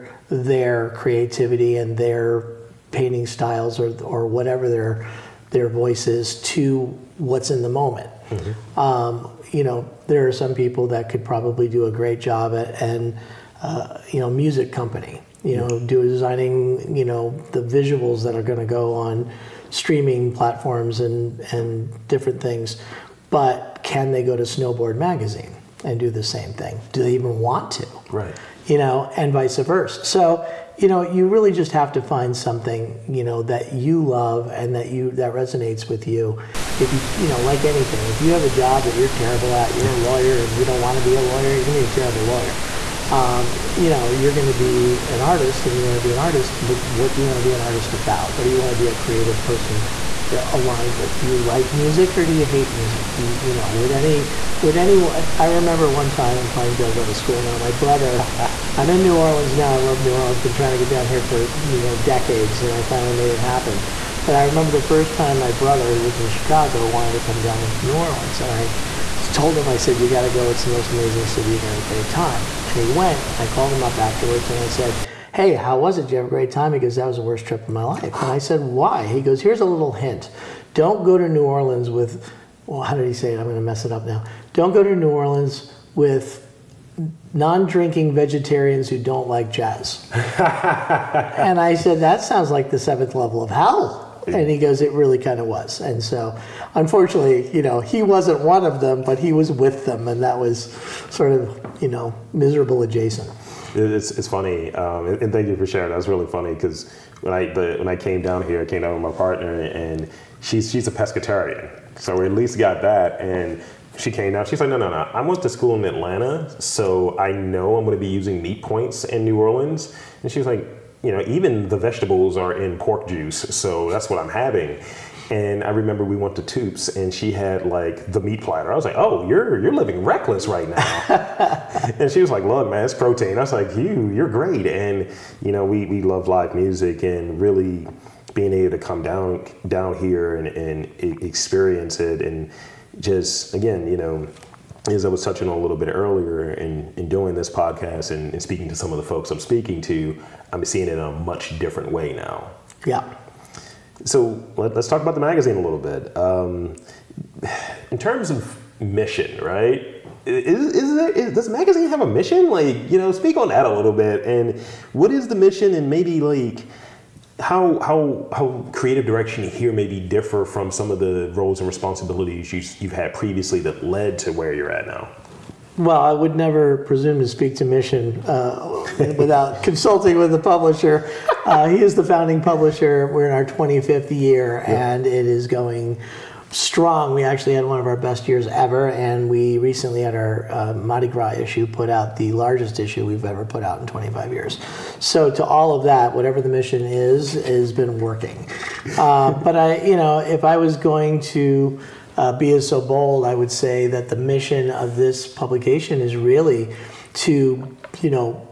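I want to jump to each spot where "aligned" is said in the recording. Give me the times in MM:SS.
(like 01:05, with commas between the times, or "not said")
00:50.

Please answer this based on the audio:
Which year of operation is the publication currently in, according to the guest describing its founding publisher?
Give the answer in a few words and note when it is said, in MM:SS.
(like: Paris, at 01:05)
25th, at 03:03.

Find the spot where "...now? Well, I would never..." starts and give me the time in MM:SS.
02:54.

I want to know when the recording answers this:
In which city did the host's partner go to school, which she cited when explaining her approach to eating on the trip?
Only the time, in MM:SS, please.
01:55.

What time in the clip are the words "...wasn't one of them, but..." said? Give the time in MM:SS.
01:38.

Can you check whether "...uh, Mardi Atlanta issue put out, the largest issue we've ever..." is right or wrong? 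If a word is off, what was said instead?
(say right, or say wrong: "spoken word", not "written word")
wrong: "Gras", not "Atlanta".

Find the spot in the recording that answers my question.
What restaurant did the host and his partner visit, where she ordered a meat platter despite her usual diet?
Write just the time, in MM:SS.
02:06.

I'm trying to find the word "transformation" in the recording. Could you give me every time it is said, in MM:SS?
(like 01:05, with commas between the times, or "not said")
not said.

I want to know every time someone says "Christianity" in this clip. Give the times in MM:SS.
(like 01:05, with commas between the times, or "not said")
not said.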